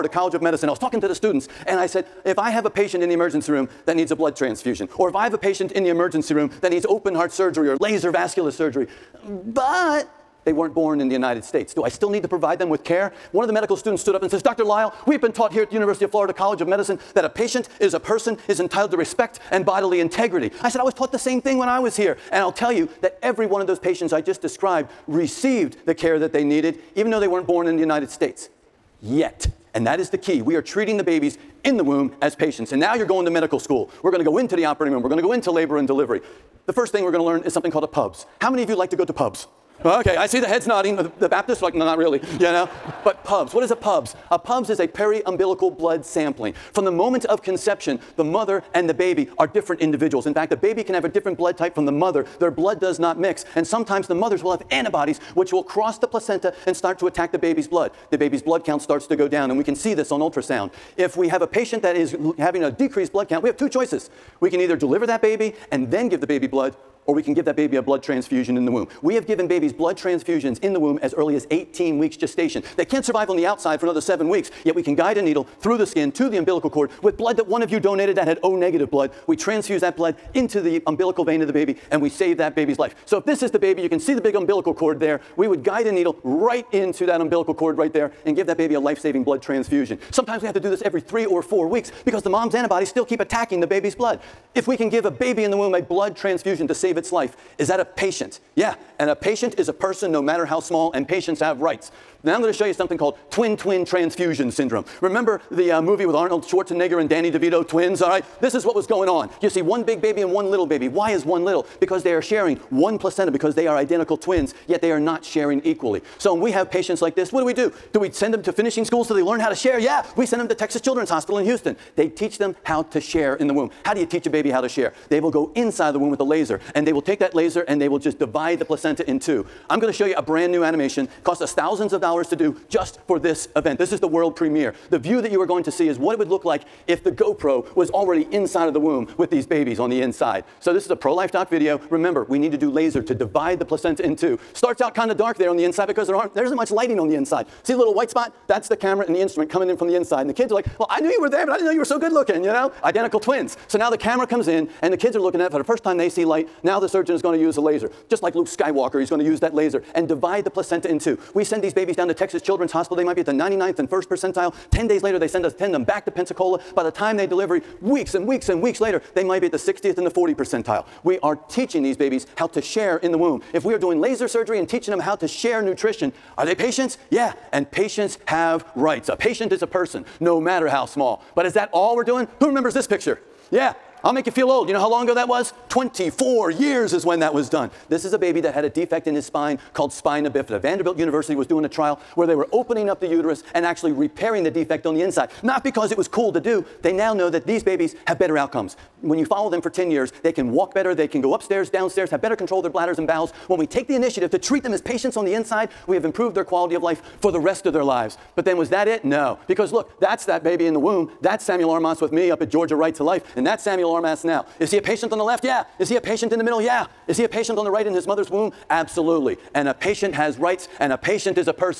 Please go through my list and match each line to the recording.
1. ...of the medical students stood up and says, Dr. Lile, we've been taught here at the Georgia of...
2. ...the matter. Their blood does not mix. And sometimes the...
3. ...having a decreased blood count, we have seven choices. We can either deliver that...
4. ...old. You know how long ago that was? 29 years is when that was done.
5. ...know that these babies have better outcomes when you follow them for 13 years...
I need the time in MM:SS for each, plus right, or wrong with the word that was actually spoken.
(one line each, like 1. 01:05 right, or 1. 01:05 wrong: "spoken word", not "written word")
1. 00:13 wrong: "University", not "Georgia"
2. 00:51 wrong: "mother", not "matter"
3. 01:02 wrong: "two", not "seven"
4. 03:04 wrong: "24", not "29"
5. 03:17 wrong: "10", not "13".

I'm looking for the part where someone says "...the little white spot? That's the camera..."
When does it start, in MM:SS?
02:27.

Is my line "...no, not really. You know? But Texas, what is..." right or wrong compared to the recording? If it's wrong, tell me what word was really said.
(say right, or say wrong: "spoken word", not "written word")
wrong: "PUBS", not "Texas".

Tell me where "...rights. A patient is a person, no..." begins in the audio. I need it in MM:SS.
02:58.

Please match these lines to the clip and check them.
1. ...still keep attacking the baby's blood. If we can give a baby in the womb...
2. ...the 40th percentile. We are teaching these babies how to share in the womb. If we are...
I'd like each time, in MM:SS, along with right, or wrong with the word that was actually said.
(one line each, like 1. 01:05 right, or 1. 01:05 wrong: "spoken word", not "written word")
1. 01:32 right
2. 02:50 right.